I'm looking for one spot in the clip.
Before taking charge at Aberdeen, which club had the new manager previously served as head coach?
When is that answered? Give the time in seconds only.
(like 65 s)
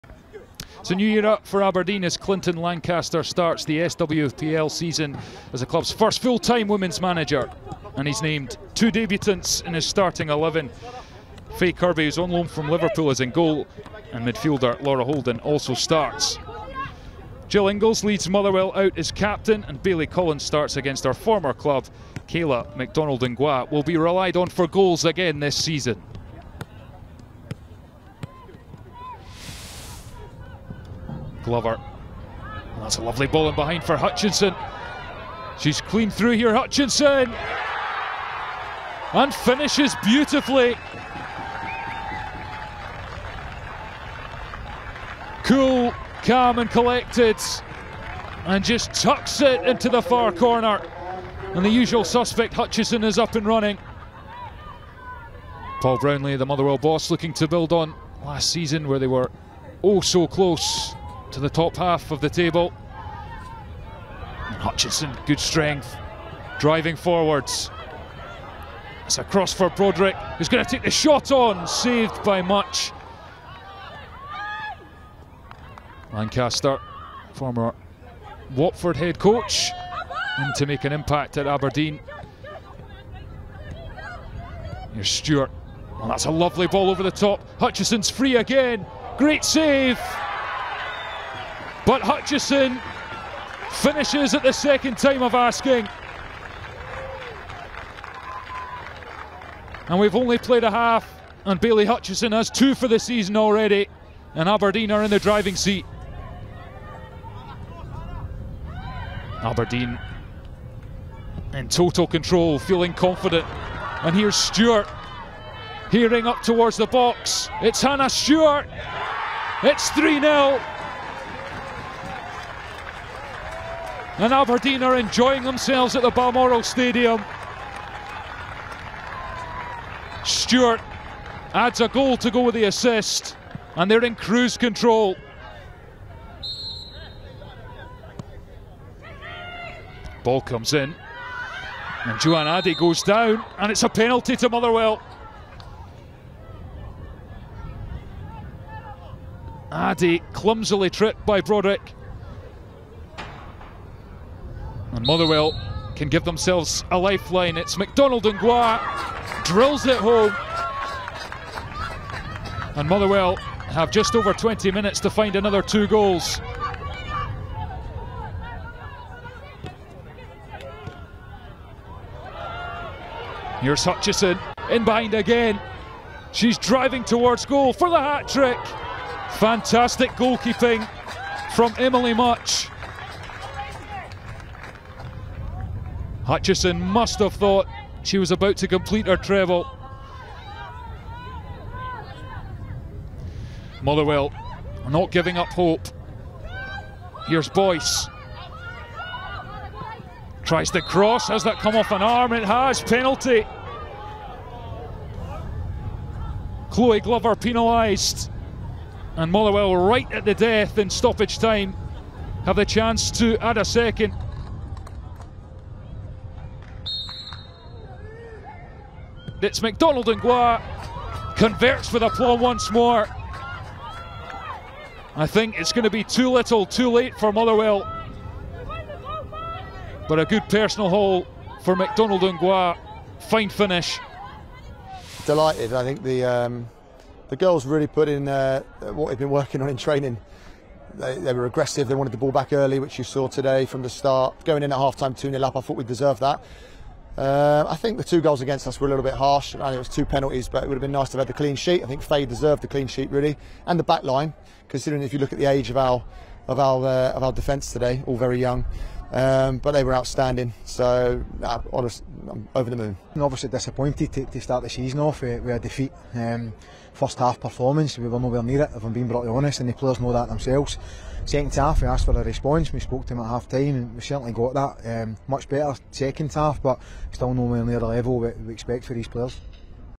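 78 s.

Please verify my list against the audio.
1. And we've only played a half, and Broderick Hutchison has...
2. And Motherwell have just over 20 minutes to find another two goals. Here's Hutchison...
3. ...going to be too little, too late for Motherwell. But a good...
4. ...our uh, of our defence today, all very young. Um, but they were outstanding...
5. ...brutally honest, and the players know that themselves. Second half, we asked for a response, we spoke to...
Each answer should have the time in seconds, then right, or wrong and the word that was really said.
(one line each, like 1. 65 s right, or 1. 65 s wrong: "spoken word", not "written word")
1. 99 s wrong: "Bayley", not "Broderick"
2. 162 s right
3. 225 s right
4. 256 s right
5. 269 s right.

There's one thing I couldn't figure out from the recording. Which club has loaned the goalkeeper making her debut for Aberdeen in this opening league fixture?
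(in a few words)
Liverpool.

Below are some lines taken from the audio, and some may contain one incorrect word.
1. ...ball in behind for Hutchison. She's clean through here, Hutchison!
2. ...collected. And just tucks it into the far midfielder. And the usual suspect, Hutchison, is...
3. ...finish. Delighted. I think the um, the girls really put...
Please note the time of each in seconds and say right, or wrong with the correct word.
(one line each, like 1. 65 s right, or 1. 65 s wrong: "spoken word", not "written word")
1. 33 s right
2. 46 s wrong: "corner", not "midfielder"
3. 233 s right.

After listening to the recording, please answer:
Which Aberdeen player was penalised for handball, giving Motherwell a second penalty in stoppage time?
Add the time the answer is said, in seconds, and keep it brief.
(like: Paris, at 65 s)
Chloe Glover, at 206 s.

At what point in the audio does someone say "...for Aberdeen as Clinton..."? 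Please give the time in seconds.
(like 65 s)
1 s.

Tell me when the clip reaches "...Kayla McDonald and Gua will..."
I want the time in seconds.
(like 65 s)
22 s.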